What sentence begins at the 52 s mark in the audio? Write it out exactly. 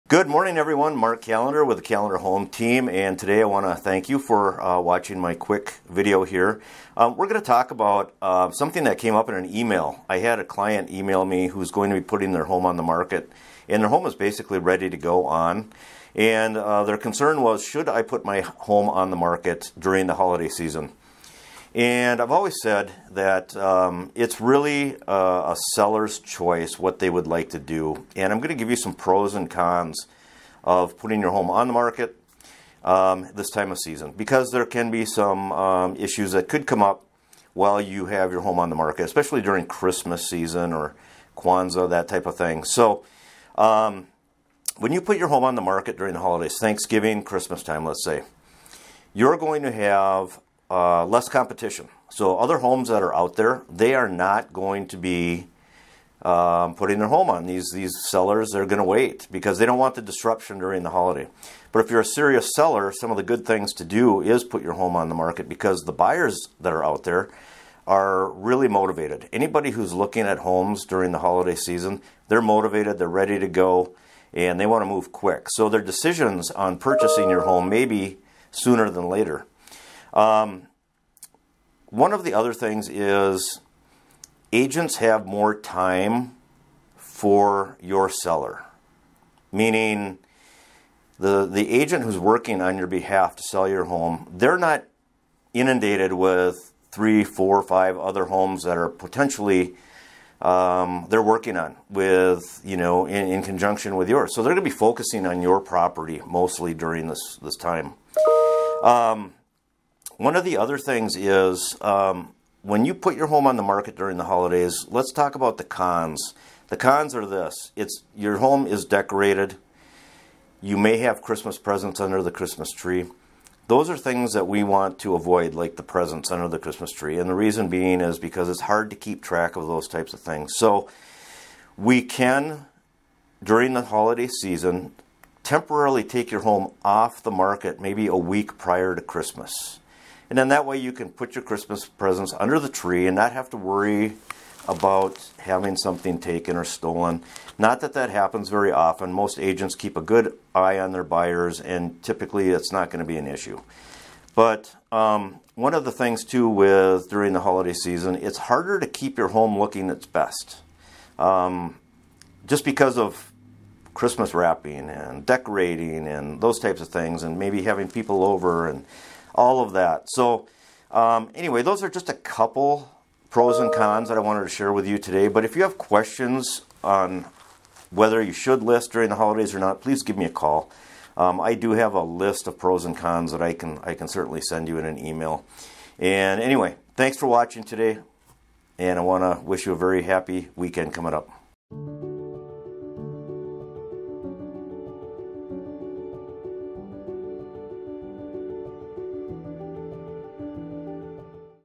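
So other homes that are out there, they are not going to be um, putting their home on these these sellers.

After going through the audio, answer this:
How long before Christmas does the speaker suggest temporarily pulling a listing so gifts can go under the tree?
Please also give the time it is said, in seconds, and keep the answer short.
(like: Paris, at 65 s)
a week, at 138 s.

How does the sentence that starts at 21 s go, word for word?
And I've always said that um, it's really a seller's choice what they would like to do.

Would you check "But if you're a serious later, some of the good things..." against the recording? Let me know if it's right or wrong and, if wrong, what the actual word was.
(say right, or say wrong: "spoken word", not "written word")
wrong: "seller", not "later".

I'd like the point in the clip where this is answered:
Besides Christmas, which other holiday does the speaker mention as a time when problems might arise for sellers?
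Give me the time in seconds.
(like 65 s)
41 s.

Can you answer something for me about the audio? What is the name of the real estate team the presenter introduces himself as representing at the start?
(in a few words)
Callender Home Team.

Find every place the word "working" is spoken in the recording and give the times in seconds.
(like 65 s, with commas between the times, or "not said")
92 s, 101 s.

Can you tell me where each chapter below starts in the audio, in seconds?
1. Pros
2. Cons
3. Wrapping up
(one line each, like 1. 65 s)
1. 50 s
2. 120 s
3. 180 s.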